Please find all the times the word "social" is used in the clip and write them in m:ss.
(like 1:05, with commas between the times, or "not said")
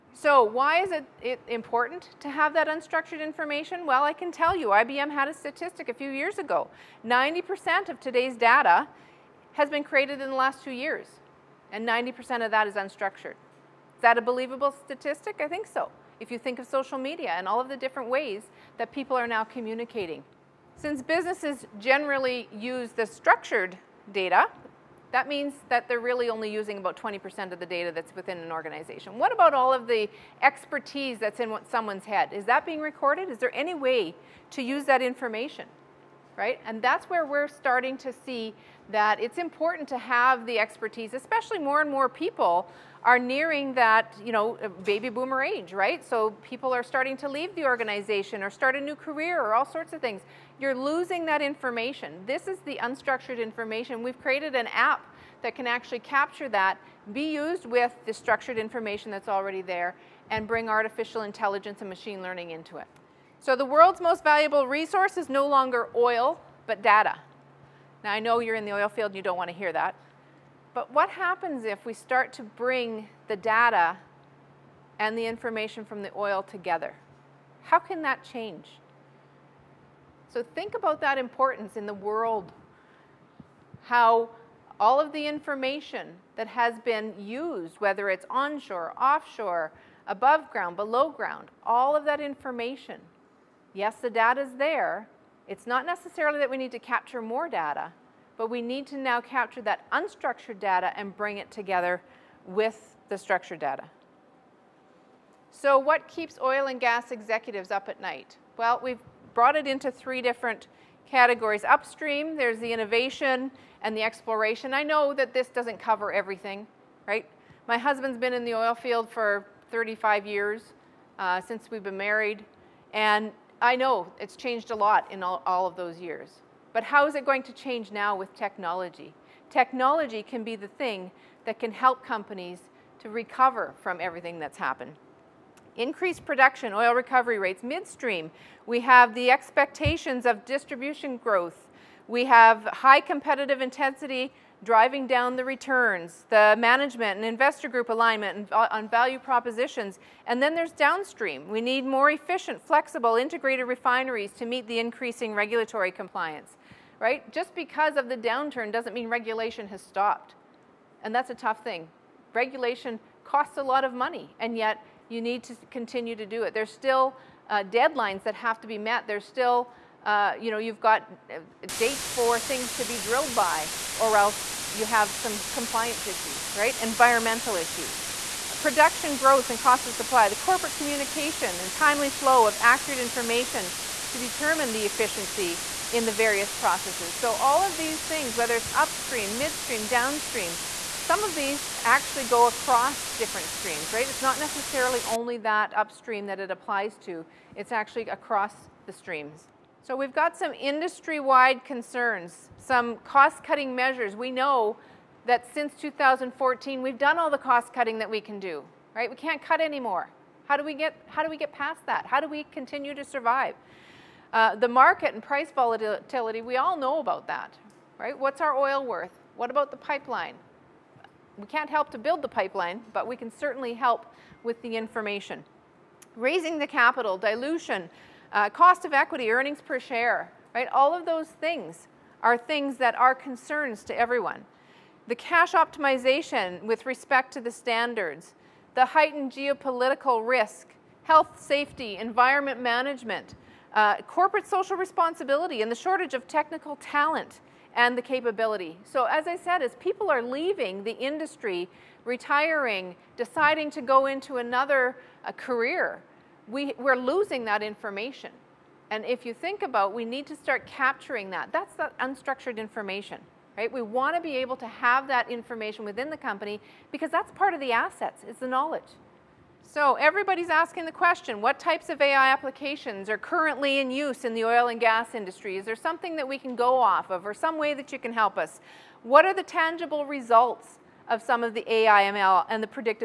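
0:16, 4:04.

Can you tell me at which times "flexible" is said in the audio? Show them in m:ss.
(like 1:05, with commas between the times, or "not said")
2:32.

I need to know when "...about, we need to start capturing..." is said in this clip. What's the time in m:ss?
4:19.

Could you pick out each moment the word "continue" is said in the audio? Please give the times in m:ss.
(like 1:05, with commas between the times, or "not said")
2:45, 3:32.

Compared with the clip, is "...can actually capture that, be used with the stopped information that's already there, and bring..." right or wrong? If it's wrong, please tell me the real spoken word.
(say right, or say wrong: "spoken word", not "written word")
wrong: "structured", not "stopped".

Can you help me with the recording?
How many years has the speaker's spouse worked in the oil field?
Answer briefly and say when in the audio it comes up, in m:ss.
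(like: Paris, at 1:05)
35 years, at 1:59.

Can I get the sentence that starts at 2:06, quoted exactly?
But how is it going to change now with technology?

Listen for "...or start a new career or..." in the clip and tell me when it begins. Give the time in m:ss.
0:48.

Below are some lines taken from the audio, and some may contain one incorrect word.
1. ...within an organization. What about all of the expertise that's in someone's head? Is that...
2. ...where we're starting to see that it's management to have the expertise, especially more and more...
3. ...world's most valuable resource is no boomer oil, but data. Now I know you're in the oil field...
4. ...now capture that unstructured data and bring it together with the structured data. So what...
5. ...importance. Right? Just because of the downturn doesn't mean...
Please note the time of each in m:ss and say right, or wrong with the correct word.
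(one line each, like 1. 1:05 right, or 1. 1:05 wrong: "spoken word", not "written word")
1. 0:28 right
2. 0:37 wrong: "important", not "management"
3. 1:03 wrong: "longer", not "boomer"
4. 1:38 right
5. 2:35 wrong: "compliance", not "importance".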